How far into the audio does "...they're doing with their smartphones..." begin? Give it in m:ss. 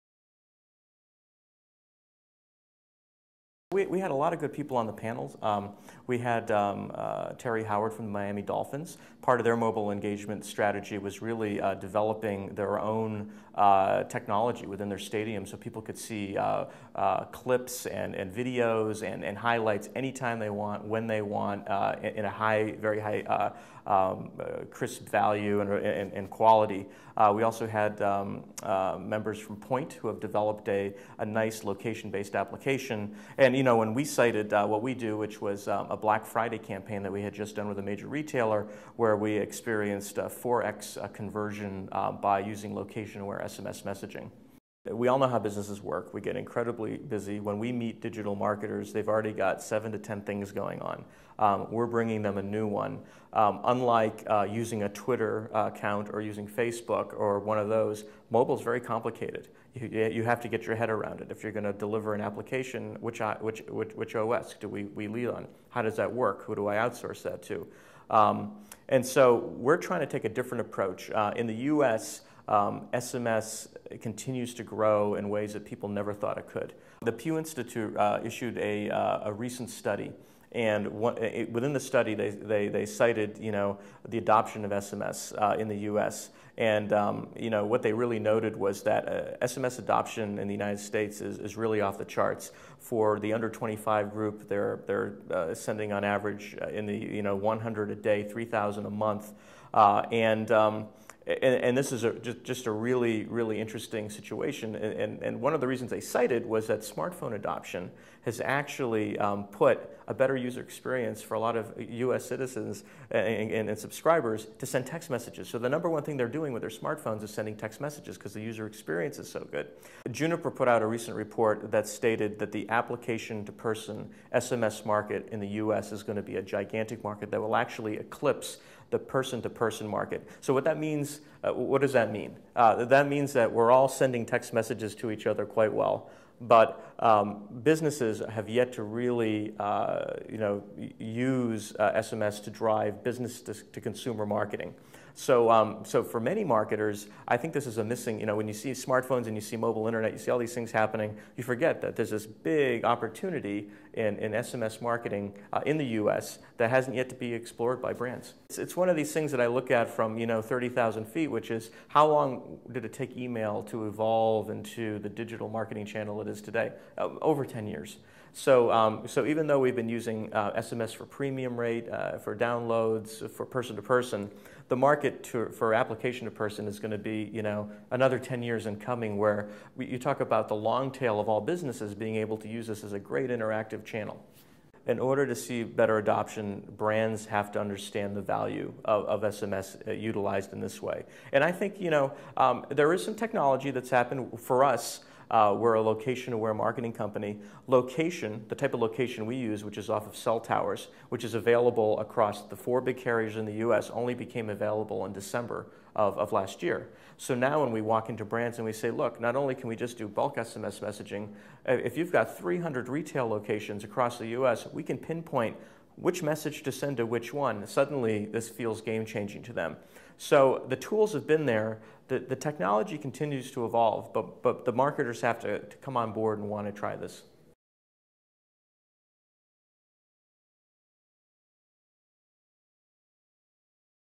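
1:56.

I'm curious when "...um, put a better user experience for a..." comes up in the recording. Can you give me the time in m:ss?
1:49.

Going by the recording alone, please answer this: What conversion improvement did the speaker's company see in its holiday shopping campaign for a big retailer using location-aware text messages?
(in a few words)
4x.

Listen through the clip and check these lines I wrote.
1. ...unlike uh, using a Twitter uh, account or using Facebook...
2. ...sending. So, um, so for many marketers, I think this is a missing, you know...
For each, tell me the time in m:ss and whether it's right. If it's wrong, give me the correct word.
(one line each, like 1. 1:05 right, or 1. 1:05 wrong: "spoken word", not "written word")
1. 0:53 right
2. 2:24 wrong: "marketing", not "sending".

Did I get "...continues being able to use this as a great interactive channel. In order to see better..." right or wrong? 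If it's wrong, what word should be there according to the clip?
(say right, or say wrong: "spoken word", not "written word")
wrong: "businesses", not "continues".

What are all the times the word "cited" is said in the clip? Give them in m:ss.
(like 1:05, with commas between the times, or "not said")
0:34, 1:22, 1:46.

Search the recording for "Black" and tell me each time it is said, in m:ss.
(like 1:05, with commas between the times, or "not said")
0:35.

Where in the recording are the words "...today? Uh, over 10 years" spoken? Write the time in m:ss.
2:46.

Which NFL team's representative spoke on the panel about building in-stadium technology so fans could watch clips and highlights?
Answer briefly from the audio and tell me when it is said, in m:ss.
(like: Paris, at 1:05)
Miami Dolphins, at 0:08.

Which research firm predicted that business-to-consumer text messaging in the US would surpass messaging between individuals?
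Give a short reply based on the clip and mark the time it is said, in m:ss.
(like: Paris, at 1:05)
Juniper, at 2:00.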